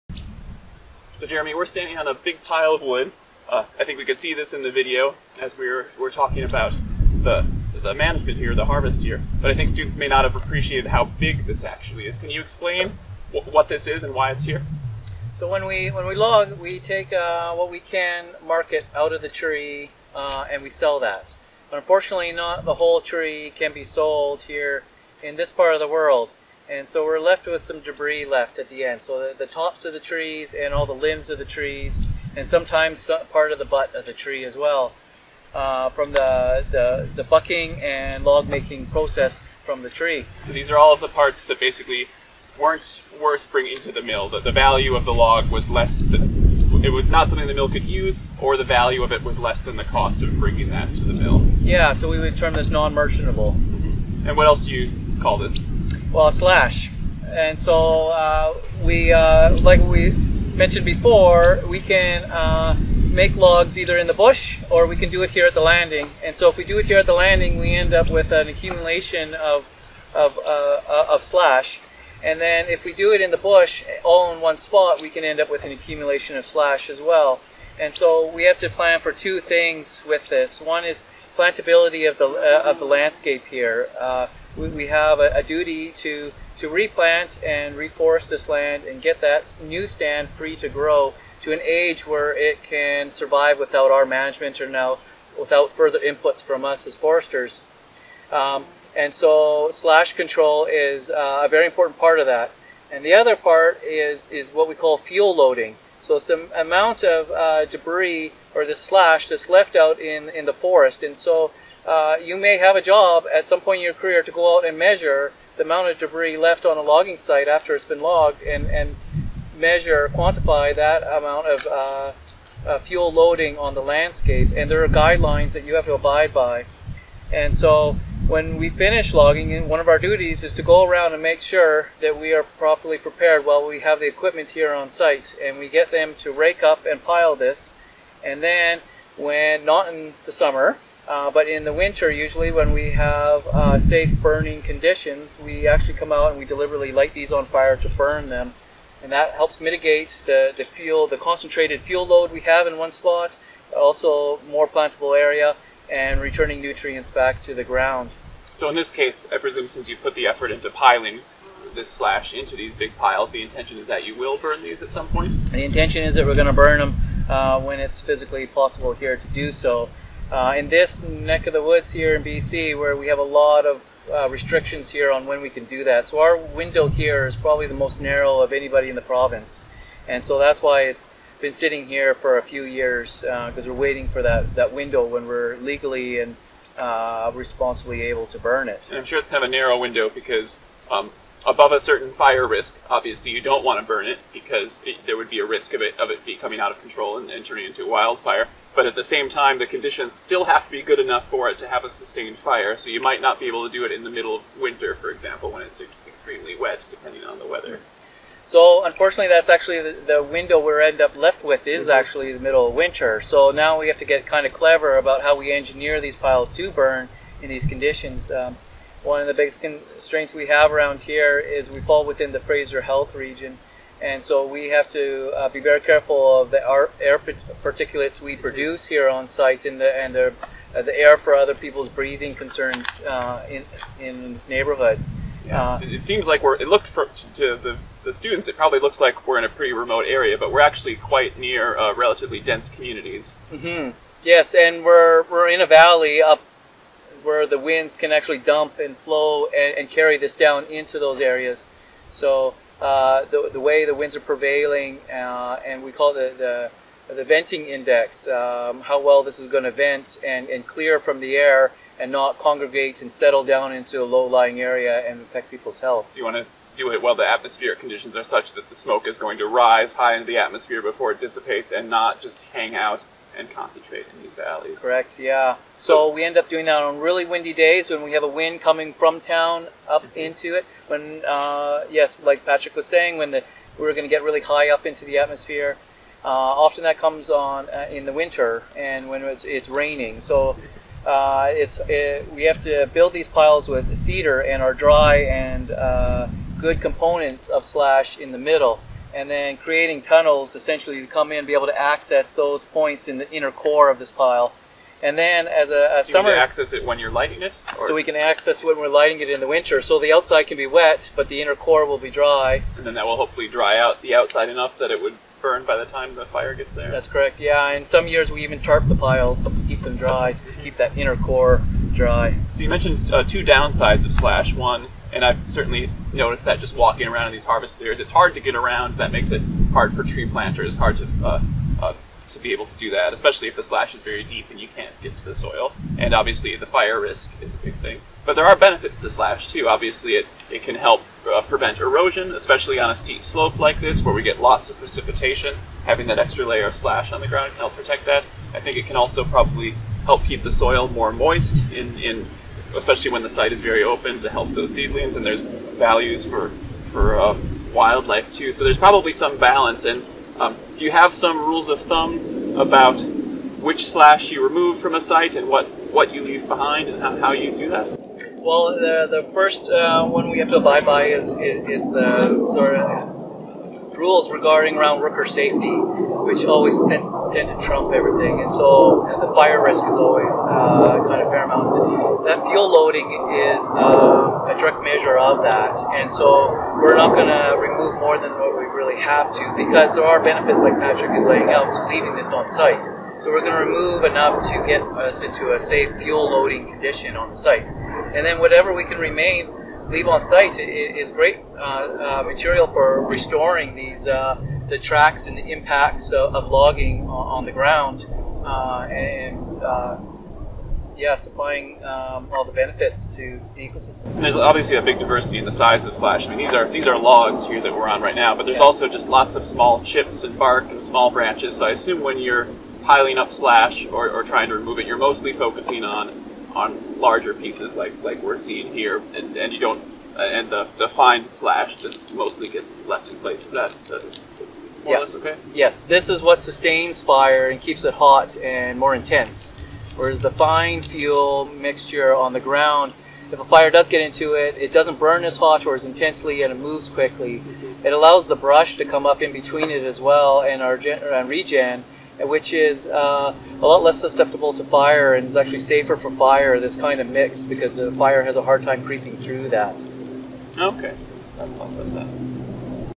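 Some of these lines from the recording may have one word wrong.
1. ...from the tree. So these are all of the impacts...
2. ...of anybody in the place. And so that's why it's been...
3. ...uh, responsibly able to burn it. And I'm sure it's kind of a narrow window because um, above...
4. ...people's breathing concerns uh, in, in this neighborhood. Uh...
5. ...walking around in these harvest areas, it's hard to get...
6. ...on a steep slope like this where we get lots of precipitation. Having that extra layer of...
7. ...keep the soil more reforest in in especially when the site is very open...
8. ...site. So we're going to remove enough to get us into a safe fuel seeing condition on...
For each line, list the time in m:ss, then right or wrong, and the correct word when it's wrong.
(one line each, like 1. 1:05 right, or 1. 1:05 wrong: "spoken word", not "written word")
1. 0:39 wrong: "parts", not "impacts"
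2. 2:58 wrong: "province", not "place"
3. 3:06 right
4. 3:51 right
5. 5:26 right
6. 5:42 right
7. 5:50 wrong: "moist", not "reforest"
8. 6:32 wrong: "loading", not "seeing".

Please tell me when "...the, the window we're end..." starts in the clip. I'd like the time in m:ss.
3:29.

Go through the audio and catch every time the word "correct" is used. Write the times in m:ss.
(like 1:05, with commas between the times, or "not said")
4:34, 5:17.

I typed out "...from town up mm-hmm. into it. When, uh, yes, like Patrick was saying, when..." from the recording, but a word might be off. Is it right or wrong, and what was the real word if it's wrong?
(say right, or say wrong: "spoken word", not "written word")
right.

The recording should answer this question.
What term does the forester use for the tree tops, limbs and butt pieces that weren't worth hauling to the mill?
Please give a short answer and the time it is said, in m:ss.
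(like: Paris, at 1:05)
non-merchantable, at 0:52.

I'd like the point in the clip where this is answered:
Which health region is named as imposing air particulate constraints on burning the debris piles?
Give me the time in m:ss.
3:42.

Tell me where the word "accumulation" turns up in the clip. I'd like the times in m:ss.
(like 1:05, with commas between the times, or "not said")
1:08, 1:15.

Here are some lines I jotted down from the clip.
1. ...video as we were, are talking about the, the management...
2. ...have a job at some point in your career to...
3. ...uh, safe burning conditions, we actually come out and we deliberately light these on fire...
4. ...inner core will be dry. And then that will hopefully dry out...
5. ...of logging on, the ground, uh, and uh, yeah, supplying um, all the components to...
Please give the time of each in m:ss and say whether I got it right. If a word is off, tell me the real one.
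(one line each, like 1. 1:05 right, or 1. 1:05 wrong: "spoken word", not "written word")
1. 0:04 right
2. 1:52 right
3. 2:23 right
4. 5:11 right
5. 6:46 wrong: "benefits", not "components".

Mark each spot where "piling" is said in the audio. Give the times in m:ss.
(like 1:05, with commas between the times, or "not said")
2:40, 7:02.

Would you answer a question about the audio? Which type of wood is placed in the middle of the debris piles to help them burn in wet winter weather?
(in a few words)
cedar.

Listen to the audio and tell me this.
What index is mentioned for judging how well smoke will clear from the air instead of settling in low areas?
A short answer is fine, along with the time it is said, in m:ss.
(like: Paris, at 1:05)
venting index, at 4:17.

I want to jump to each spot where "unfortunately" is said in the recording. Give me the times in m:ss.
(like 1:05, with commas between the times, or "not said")
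0:21, 3:28.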